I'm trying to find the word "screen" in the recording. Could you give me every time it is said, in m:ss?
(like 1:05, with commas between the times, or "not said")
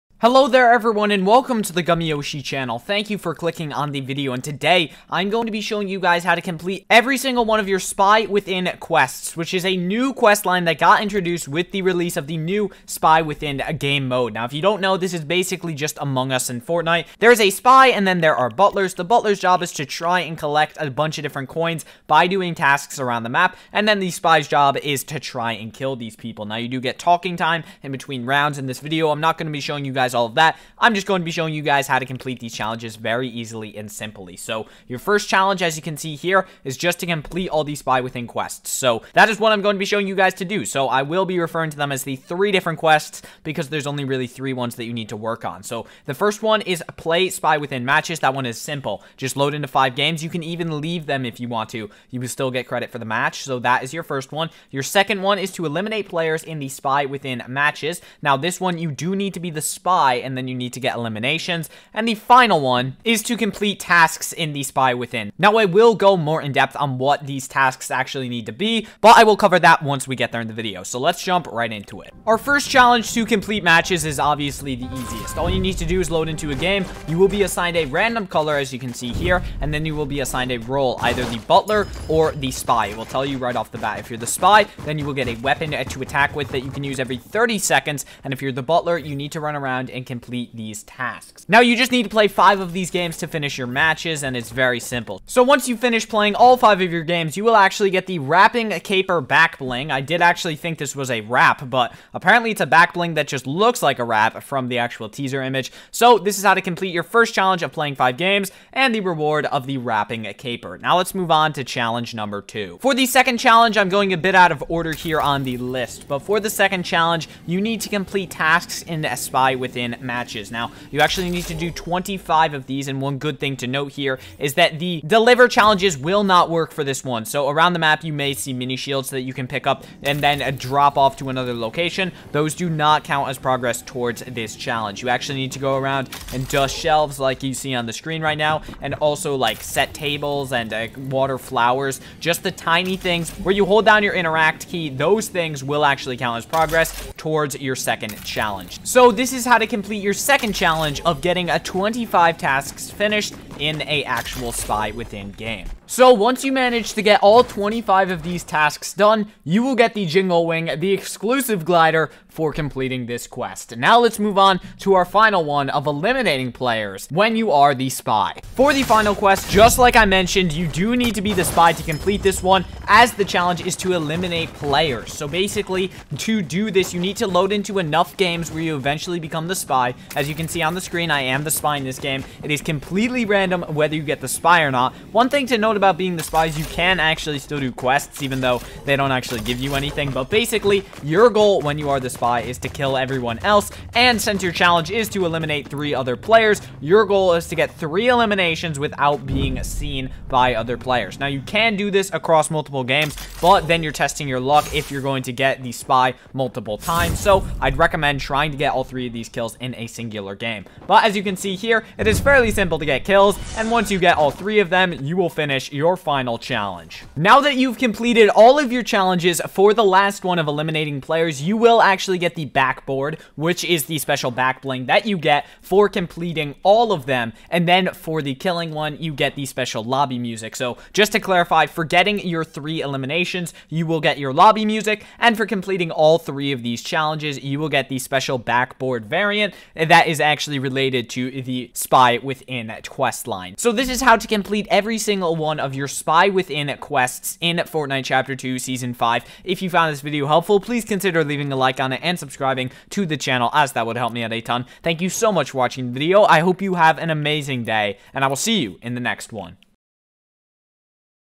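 2:17, 3:00.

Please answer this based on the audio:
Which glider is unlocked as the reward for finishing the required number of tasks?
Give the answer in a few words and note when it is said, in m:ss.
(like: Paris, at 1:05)
Jingle Wing, at 2:40.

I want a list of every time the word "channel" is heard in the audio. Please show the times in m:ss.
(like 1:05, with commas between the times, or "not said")
0:02, 4:13.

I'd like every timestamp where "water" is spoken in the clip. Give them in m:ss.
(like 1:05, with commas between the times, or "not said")
2:21.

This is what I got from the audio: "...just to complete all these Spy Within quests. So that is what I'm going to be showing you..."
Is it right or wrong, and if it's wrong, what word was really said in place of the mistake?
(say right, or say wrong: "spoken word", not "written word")
right.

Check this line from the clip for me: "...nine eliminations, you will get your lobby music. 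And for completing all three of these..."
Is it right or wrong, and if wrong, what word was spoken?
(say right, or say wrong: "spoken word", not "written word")
wrong: "three", not "nine".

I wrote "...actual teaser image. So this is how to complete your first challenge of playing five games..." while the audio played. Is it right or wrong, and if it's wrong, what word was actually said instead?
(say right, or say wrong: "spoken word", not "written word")
right.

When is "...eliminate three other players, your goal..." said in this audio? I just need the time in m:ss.
3:15.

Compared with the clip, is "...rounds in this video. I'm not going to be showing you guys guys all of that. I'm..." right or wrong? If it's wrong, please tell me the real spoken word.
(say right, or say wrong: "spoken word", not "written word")
right.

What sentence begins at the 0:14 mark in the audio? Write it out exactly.
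Now if you don't know, this is basically just Among Us in Fortnite.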